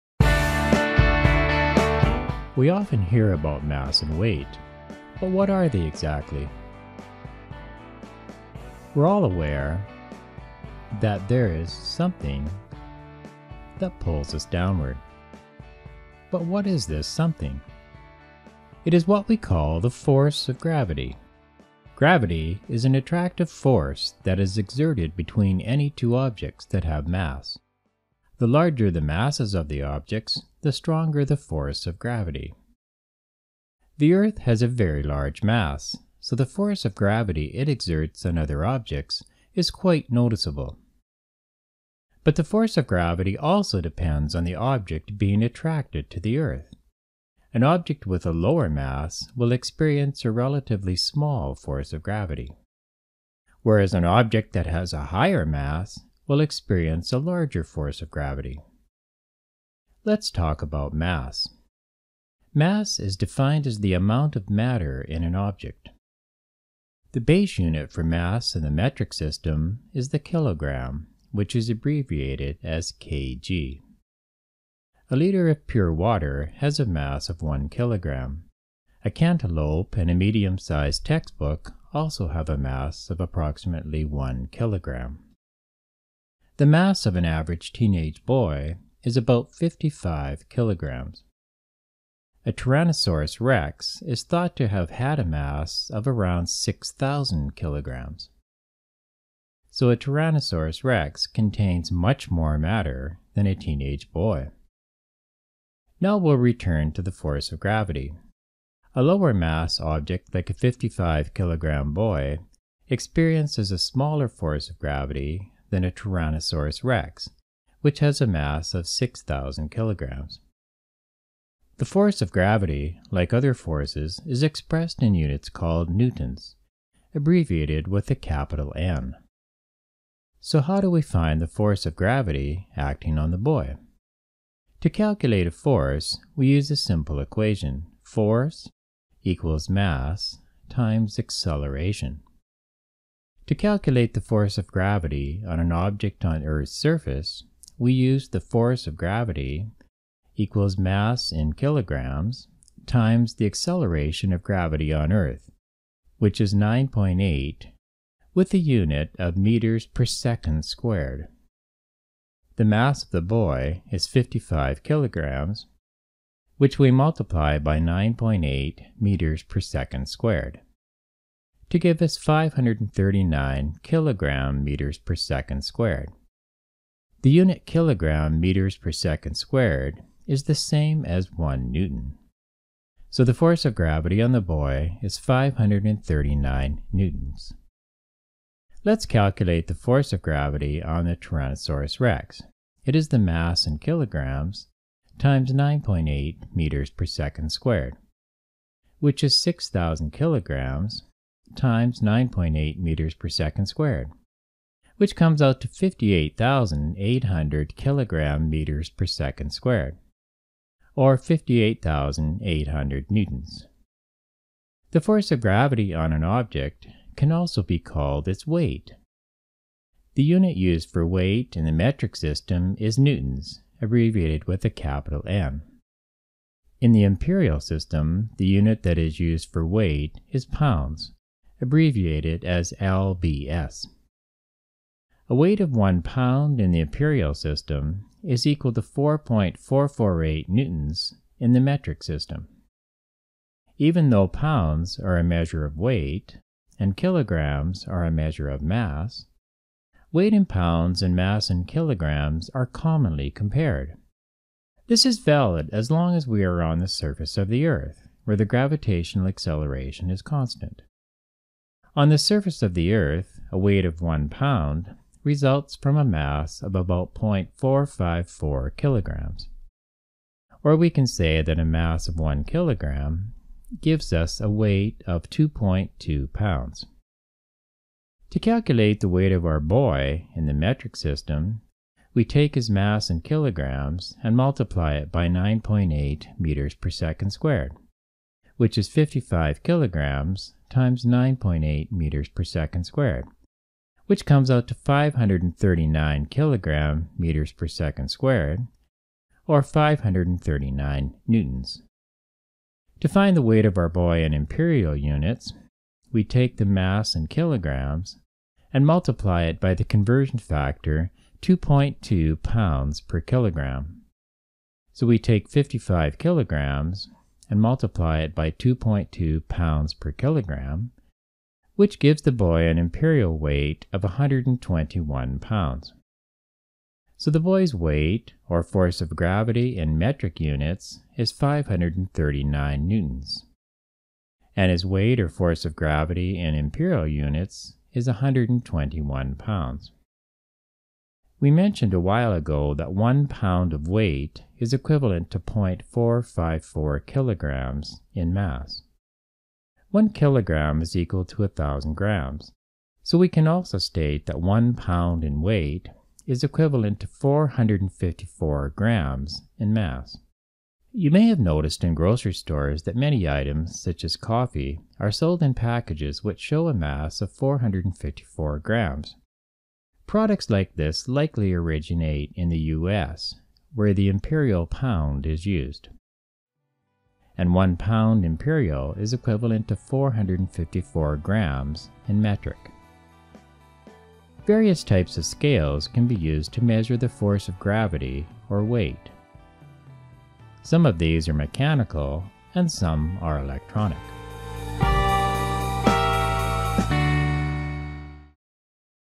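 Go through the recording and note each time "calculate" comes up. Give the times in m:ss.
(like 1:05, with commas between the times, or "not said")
2:14, 2:23, 3:09, 4:38.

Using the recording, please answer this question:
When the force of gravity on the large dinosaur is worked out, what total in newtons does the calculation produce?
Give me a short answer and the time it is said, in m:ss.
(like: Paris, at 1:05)
58,800 newtons, at 3:31.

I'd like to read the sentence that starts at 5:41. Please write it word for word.
We mentioned a while ago that one pound of weight is equivalent to 0.454 kilograms in mass.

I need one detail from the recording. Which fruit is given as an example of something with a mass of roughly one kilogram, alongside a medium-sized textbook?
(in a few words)
cantaloupe.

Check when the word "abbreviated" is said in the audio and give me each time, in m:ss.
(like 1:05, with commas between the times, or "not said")
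1:11, 2:07, 3:43, 3:51.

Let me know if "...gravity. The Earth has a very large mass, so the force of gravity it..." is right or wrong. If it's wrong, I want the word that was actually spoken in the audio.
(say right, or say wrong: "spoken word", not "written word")
right.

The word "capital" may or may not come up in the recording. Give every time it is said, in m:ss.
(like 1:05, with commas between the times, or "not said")
2:08, 3:44.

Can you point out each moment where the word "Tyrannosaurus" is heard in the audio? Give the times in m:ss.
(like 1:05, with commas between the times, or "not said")
1:32, 1:39, 1:55, 3:11.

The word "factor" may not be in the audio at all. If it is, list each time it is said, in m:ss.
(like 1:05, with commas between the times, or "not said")
5:10.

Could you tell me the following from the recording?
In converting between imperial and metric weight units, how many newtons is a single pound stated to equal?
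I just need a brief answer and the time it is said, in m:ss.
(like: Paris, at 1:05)
4.448 newtons, at 3:58.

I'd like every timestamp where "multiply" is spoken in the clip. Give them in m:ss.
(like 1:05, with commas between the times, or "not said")
2:46, 4:44, 5:08, 5:17.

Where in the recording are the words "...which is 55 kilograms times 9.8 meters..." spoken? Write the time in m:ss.
4:48.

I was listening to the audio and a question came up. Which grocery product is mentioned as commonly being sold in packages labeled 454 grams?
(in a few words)
coffee.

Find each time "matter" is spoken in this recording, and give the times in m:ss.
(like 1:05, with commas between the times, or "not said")
1:04, 1:42.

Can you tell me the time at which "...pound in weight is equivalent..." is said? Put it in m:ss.
5:54.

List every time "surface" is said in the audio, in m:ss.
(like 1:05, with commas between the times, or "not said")
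2:26, 4:16, 4:22.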